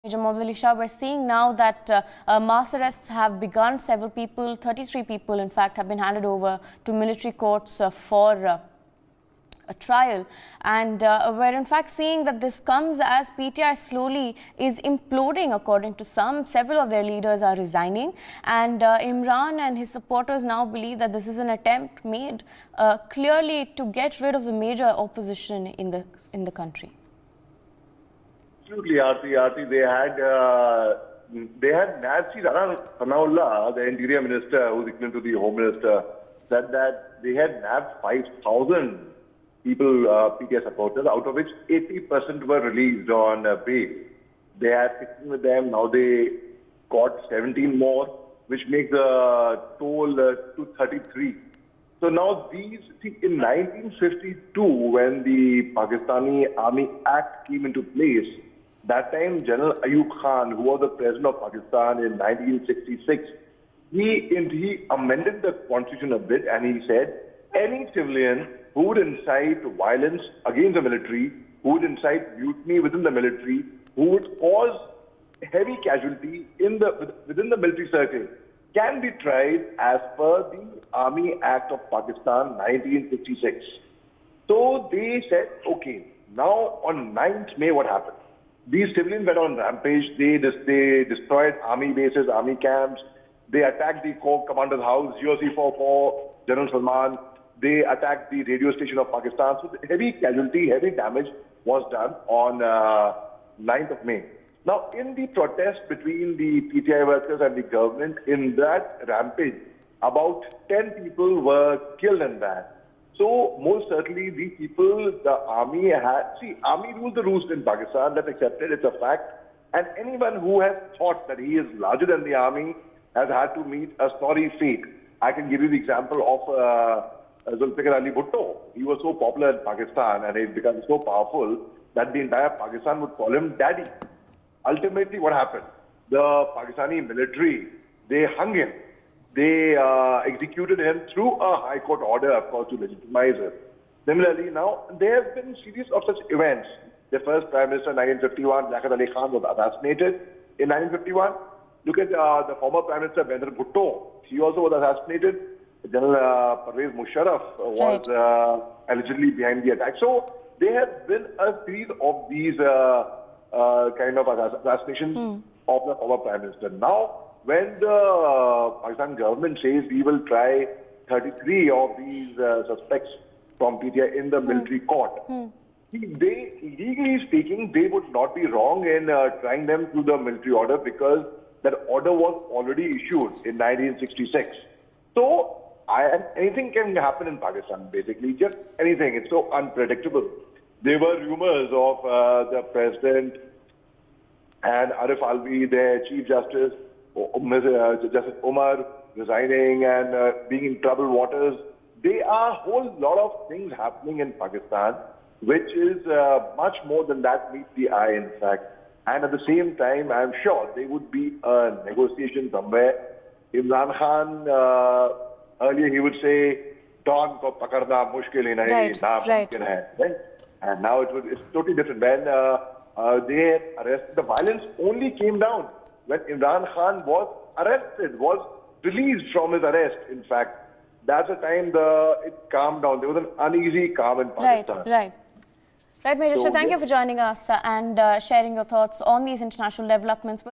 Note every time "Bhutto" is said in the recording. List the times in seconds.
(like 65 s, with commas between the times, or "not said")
128 s, 153 s.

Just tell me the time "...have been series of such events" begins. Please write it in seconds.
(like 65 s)
145 s.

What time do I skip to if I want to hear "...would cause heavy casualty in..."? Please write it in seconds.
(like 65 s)
74 s.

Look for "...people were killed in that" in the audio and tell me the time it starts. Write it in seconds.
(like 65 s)
111 s.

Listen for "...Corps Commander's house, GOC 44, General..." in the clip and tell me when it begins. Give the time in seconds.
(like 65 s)
94 s.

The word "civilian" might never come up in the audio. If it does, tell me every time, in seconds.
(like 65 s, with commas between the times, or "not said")
67 s, 88 s.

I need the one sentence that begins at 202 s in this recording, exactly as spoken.
There are a whole lot of things happening in Pakistan, which is uh, much more than that meets the eye, in fact.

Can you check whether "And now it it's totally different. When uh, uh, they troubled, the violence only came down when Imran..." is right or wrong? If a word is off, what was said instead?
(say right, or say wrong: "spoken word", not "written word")
wrong: "arrested", not "troubled".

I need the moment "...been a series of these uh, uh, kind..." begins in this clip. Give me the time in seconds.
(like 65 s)
161 s.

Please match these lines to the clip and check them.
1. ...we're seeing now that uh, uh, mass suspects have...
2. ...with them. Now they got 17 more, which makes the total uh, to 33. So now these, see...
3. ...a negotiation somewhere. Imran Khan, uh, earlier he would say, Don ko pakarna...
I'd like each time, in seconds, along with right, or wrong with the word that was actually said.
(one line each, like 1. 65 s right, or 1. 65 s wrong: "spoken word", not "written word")
1. 0 s wrong: "arrests", not "suspects"
2. 45 s right
3. 211 s right.